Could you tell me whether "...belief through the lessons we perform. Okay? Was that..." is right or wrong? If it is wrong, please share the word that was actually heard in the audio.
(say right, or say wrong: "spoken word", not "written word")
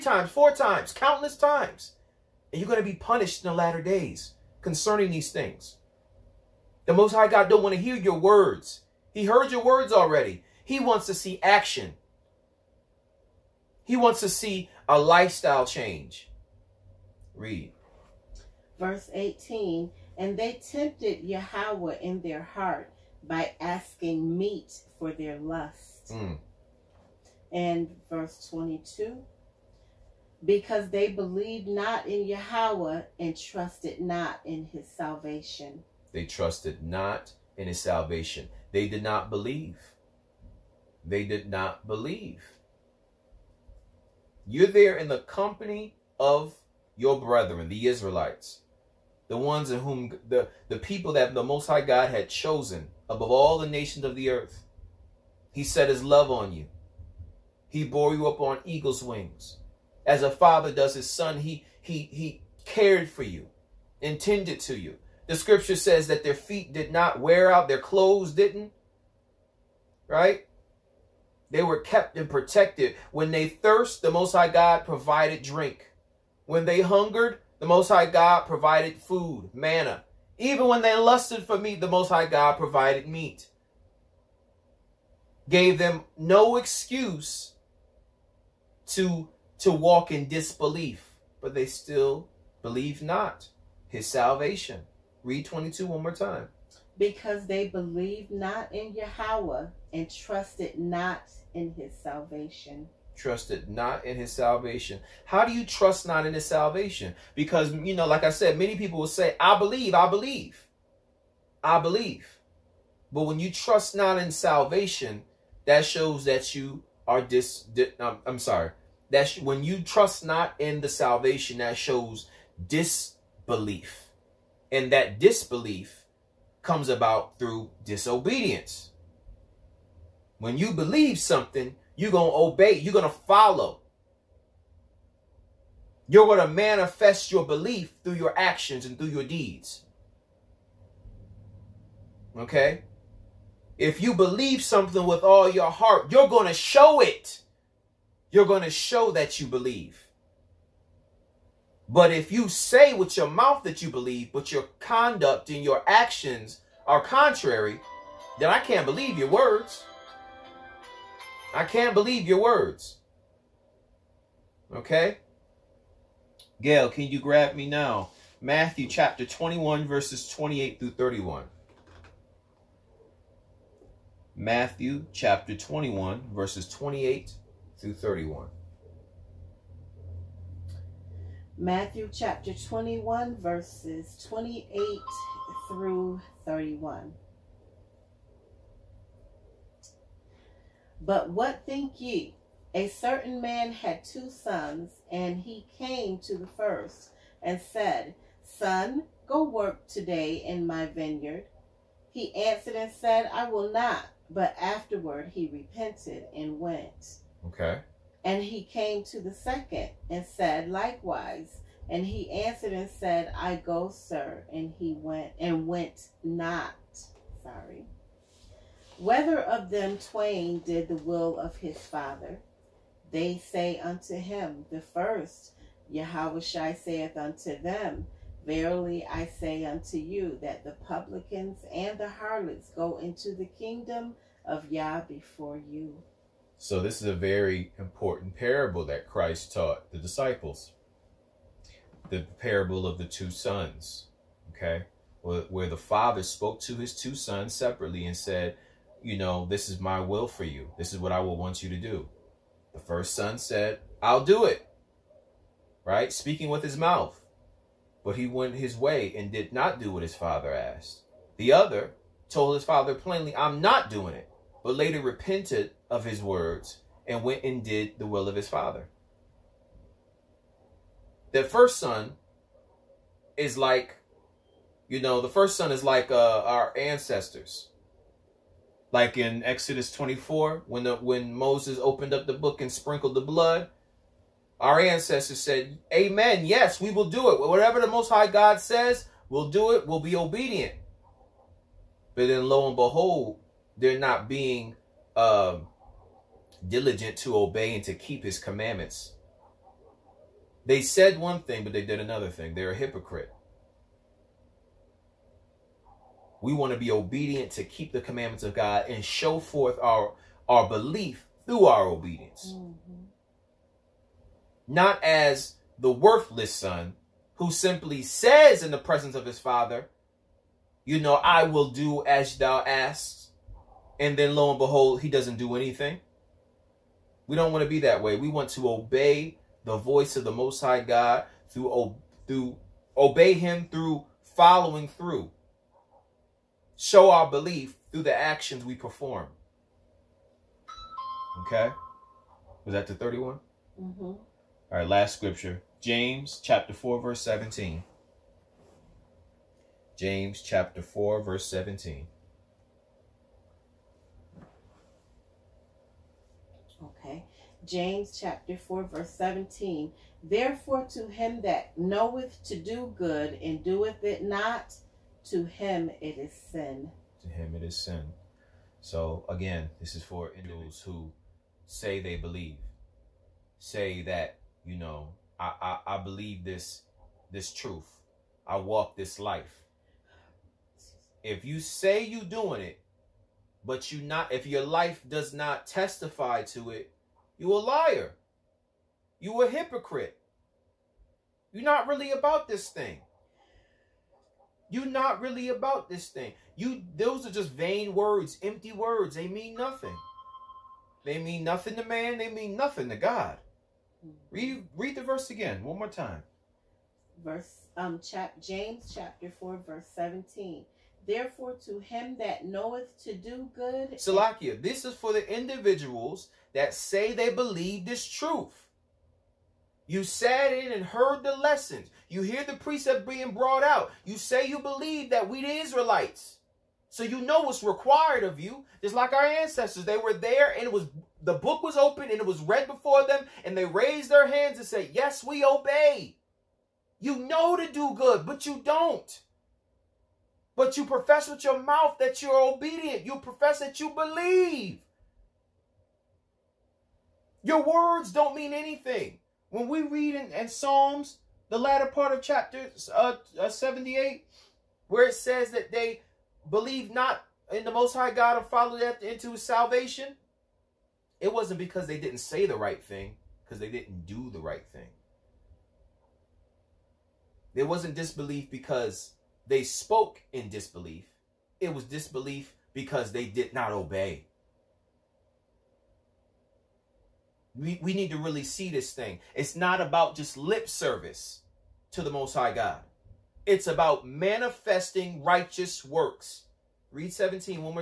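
wrong: "actions", not "lessons".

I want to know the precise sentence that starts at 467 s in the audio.
There wasn't disbelief because they spoke in disbelief.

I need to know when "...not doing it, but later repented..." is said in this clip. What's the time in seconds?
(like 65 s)
263 s.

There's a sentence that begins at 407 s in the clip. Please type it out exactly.
Verse um chap James chapter 4 verse 17.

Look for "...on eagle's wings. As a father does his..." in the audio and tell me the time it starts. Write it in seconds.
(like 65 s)
58 s.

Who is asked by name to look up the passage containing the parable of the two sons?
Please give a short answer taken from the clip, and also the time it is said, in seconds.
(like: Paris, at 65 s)
Gail, at 166 s.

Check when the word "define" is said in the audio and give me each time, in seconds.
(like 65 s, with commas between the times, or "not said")
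not said.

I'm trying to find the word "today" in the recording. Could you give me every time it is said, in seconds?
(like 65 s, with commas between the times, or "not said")
199 s.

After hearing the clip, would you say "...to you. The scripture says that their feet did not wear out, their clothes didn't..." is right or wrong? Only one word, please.
right.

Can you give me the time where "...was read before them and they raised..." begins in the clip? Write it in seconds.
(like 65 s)
432 s.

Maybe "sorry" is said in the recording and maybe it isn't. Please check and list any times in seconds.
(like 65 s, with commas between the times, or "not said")
118 s, 217 s.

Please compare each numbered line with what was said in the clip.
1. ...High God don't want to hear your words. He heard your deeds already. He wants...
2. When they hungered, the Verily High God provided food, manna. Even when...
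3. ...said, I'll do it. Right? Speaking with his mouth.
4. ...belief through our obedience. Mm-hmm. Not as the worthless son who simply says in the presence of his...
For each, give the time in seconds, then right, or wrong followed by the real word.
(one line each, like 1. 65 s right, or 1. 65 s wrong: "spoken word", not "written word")
1. 7 s wrong: "words", not "deeds"
2. 76 s wrong: "Most", not "Verily"
3. 253 s right
4. 310 s right.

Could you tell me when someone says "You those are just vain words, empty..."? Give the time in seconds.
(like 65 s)
396 s.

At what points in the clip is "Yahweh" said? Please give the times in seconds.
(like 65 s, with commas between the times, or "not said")
21 s, 32 s, 98 s.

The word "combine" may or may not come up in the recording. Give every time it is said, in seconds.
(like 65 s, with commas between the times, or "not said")
not said.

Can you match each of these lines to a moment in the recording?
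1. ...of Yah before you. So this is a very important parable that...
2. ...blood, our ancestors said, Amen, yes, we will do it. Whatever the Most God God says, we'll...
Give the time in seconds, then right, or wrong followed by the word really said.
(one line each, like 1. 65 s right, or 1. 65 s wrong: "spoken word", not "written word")
1. 234 s right
2. 283 s wrong: "High", not "God".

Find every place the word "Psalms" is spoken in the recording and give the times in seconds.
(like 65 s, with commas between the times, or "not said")
450 s.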